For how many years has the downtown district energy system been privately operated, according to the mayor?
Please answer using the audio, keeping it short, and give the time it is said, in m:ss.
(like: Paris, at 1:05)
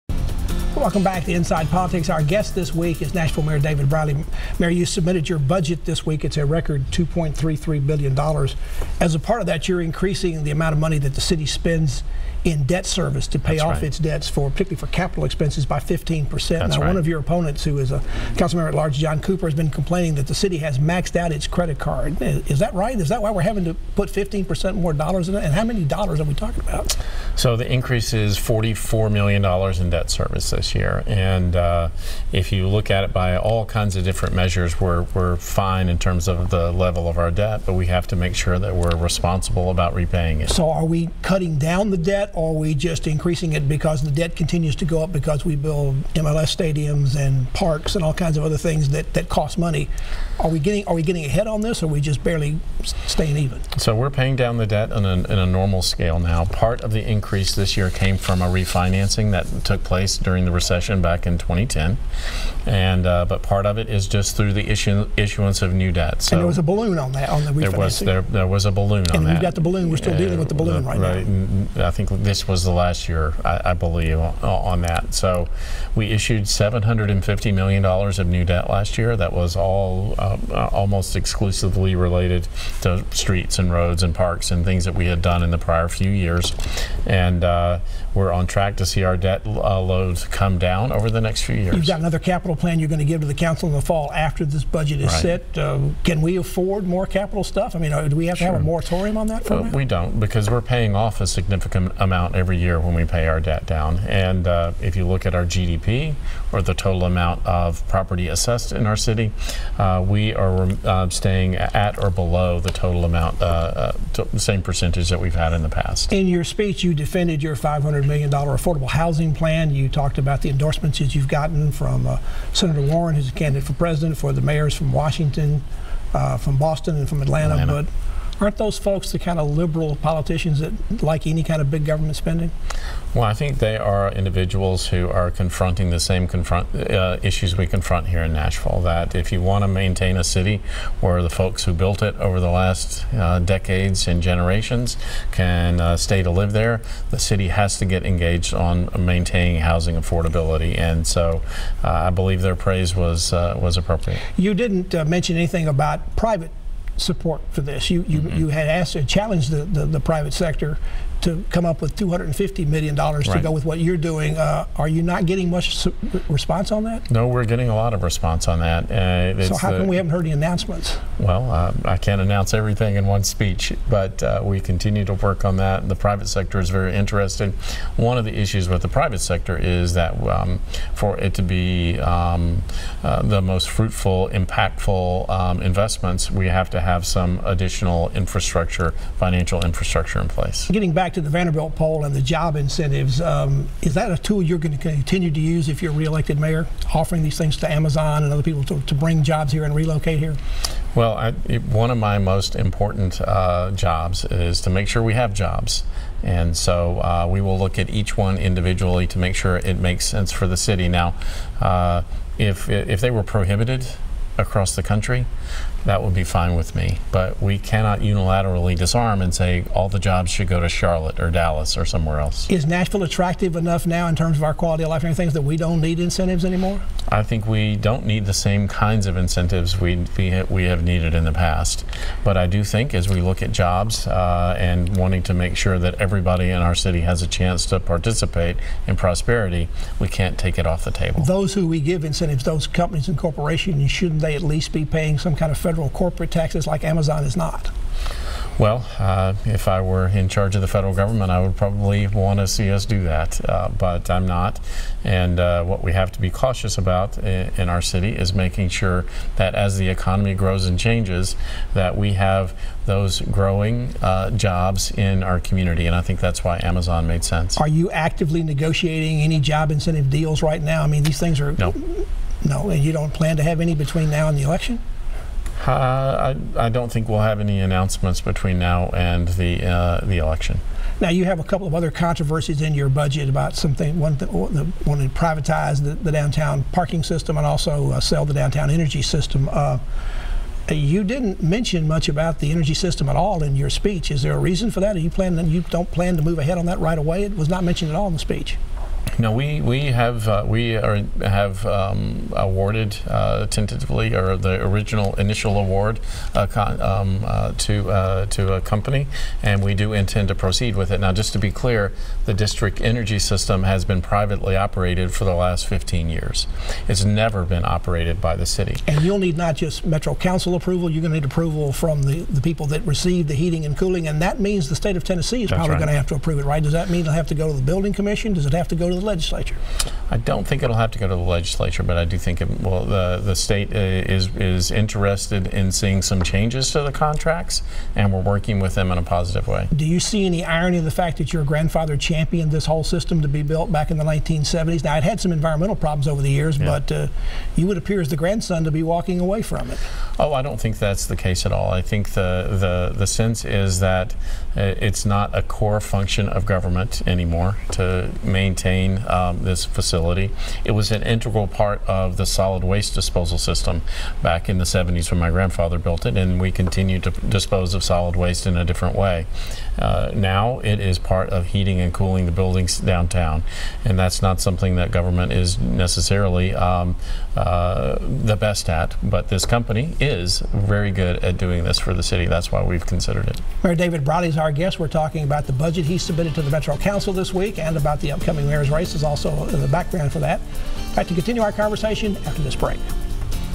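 15 years, at 5:15.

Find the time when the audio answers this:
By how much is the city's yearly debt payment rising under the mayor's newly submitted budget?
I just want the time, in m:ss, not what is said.
0:28.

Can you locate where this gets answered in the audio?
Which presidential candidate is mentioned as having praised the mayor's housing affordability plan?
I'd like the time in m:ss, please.
2:02.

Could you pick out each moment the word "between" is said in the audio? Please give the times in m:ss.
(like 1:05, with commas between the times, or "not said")
4:33, 4:38.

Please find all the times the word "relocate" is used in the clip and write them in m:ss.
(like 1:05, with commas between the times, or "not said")
3:19.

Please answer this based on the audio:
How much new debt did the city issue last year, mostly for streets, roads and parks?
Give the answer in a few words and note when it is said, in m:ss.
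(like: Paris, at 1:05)
$750 million, at 1:16.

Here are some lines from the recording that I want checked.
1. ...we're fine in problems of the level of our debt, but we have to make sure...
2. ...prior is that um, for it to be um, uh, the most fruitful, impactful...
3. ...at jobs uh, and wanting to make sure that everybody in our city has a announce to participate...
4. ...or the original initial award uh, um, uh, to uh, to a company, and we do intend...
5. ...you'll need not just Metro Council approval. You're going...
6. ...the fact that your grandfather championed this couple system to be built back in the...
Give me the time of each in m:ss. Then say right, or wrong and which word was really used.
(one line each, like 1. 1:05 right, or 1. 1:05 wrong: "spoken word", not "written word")
1. 0:35 wrong: "terms", not "problems"
2. 2:59 wrong: "sector", not "prior"
3. 3:53 wrong: "chance", not "announce"
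4. 5:04 right
5. 5:19 right
6. 5:40 wrong: "whole", not "couple".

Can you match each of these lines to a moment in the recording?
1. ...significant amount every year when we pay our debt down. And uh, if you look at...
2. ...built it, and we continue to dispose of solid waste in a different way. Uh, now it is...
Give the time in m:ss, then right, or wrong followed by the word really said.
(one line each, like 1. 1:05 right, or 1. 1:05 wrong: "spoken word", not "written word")
1. 1:41 right
2. 6:05 right.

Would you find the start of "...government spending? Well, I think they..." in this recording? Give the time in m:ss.
2:11.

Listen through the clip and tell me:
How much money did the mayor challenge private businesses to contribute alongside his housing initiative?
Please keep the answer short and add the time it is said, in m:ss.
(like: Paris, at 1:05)
$250 million, at 2:41.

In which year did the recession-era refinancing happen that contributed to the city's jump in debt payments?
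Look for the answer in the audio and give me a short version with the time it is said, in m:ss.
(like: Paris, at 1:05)
2010, at 1:01.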